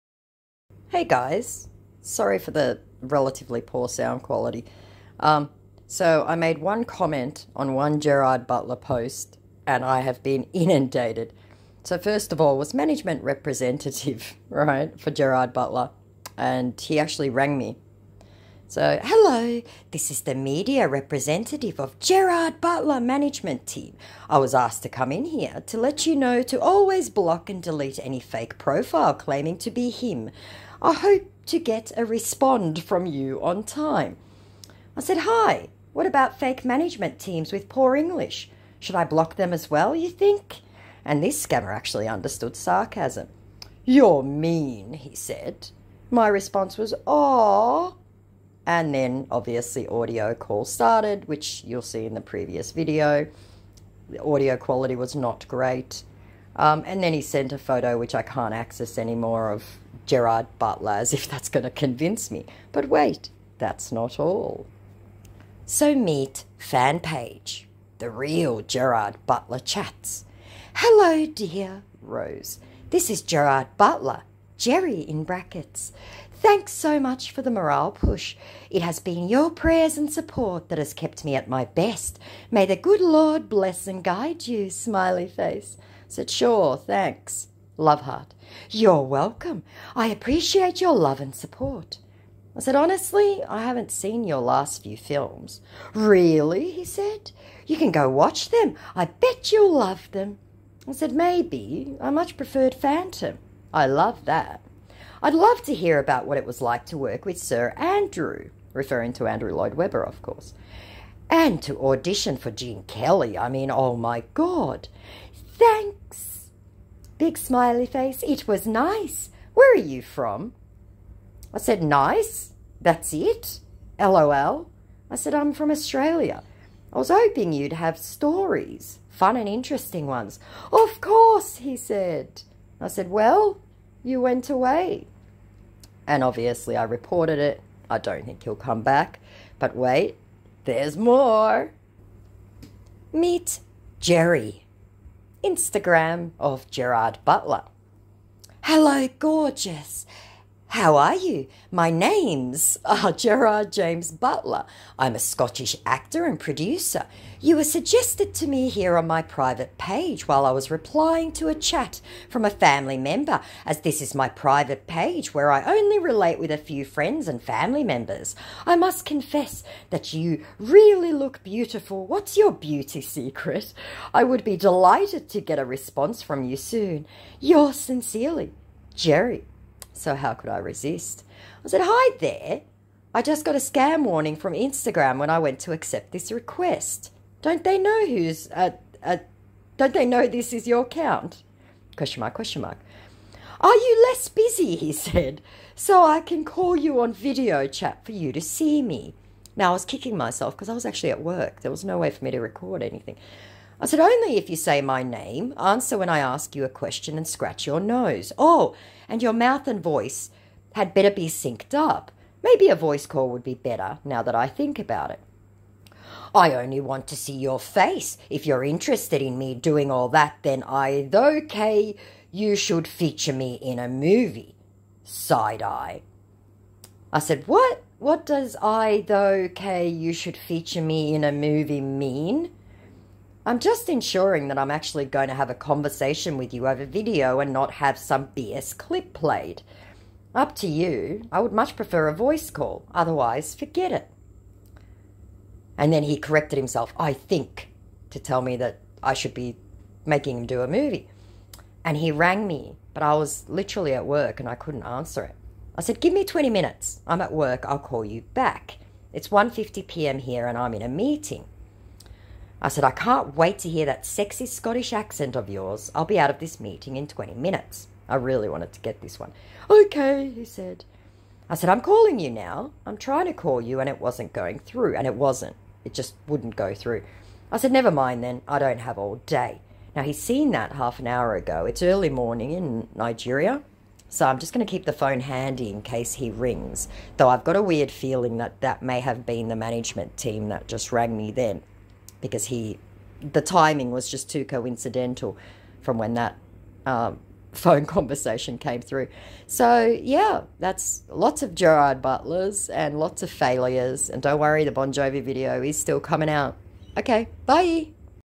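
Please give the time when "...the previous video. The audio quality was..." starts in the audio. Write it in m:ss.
0:52.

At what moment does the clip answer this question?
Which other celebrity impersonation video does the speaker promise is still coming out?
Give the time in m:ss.
5:04.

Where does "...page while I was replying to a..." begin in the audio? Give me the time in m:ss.
2:39.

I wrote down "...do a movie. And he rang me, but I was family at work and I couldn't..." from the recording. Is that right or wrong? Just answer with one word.
wrong.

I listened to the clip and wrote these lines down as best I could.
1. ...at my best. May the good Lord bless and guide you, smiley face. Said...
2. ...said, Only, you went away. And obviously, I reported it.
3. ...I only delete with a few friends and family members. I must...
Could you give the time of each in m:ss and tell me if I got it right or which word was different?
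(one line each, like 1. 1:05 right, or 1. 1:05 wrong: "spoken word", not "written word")
1. 1:21 right
2. 2:12 wrong: "Well", not "Only"
3. 2:45 wrong: "relate", not "delete".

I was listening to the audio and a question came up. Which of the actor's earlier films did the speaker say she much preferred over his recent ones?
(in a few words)
Phantom.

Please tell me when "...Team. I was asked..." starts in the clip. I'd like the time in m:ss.
0:23.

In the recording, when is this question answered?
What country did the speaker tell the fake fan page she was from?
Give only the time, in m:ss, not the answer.
2:05.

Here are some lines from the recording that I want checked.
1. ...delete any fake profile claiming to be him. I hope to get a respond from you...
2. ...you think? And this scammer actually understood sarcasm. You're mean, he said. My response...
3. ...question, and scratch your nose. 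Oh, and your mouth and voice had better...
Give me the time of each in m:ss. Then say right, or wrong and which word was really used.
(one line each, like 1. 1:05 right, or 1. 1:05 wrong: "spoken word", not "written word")
1. 0:27 right
2. 0:39 right
3. 3:26 right.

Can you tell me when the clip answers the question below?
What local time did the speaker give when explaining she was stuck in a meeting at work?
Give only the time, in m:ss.
4:19.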